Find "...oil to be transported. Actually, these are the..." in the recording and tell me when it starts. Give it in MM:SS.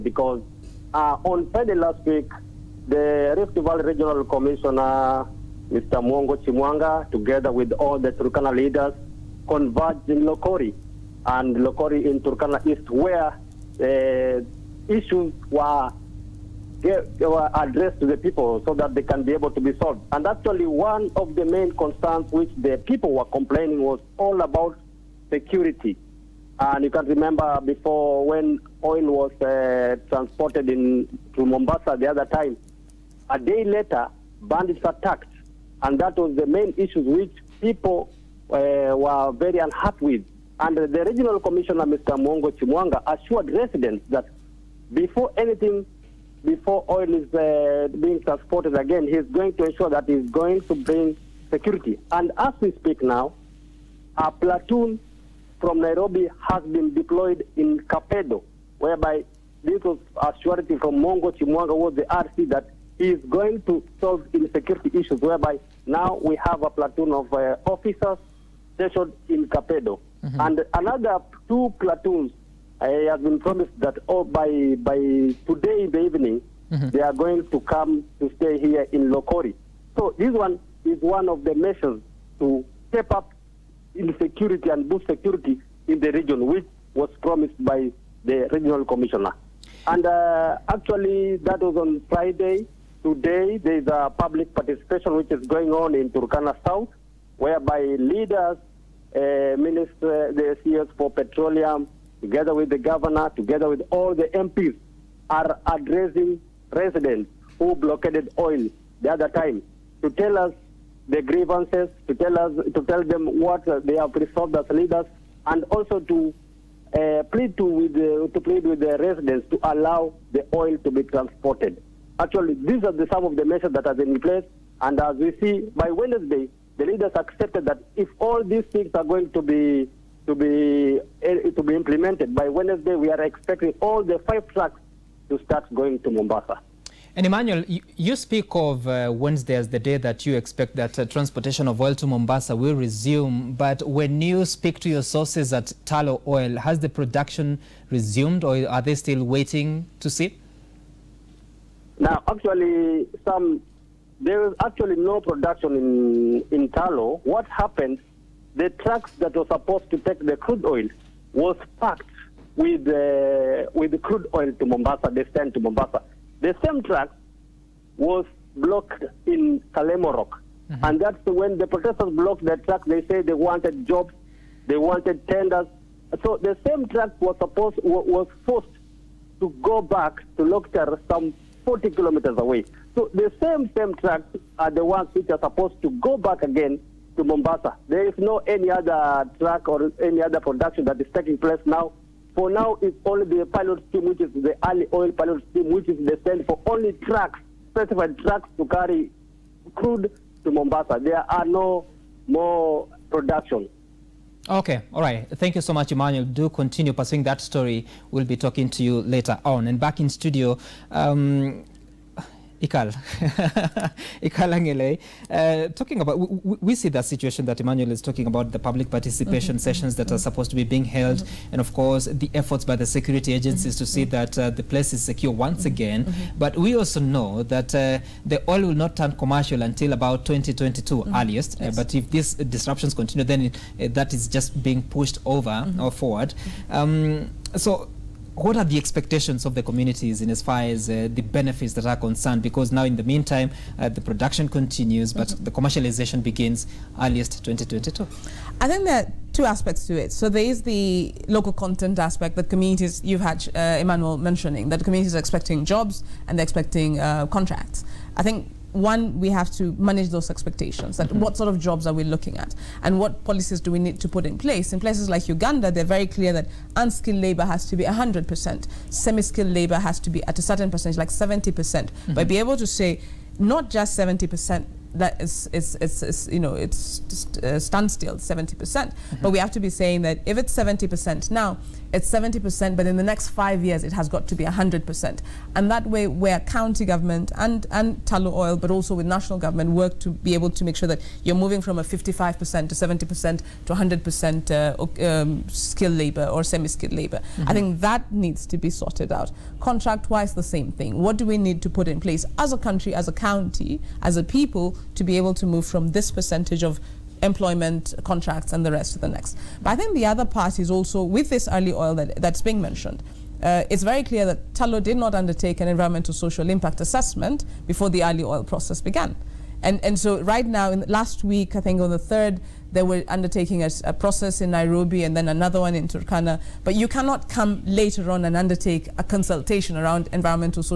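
02:00.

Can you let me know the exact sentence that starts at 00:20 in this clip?
And actually, one of the main concerns which the people were complaining was all about security.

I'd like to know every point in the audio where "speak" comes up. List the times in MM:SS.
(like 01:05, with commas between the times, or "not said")
00:52, 02:18, 02:24.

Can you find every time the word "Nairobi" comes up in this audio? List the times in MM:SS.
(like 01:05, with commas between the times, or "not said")
00:55, 05:24.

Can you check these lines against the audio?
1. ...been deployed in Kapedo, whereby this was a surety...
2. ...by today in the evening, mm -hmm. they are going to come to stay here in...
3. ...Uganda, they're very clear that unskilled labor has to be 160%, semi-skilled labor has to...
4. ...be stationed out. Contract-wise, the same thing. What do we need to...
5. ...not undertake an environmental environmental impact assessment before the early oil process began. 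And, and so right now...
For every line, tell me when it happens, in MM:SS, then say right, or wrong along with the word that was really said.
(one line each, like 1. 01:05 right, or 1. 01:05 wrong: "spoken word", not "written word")
1. 00:56 right
2. 01:14 right
3. 04:25 wrong: "100", not "160"
4. 04:58 wrong: "sorted", not "stationed"
5. 05:14 wrong: "social", not "environmental".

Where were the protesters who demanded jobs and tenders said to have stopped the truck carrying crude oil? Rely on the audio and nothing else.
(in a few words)
Kalemngorok.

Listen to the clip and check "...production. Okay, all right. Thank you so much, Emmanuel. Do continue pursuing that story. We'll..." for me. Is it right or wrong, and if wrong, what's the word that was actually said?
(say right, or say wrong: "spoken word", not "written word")
right.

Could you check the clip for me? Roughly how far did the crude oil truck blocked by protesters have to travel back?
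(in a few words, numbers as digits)
40 kilometers.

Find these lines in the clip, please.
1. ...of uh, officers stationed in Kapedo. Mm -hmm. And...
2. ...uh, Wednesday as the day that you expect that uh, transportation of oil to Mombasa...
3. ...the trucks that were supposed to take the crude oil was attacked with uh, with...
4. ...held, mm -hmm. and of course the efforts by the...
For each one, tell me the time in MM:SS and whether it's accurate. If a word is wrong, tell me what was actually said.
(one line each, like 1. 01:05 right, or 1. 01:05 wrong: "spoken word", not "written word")
1. 01:07 right
2. 02:18 right
3. 02:38 wrong: "packed", not "attacked"
4. 03:40 right.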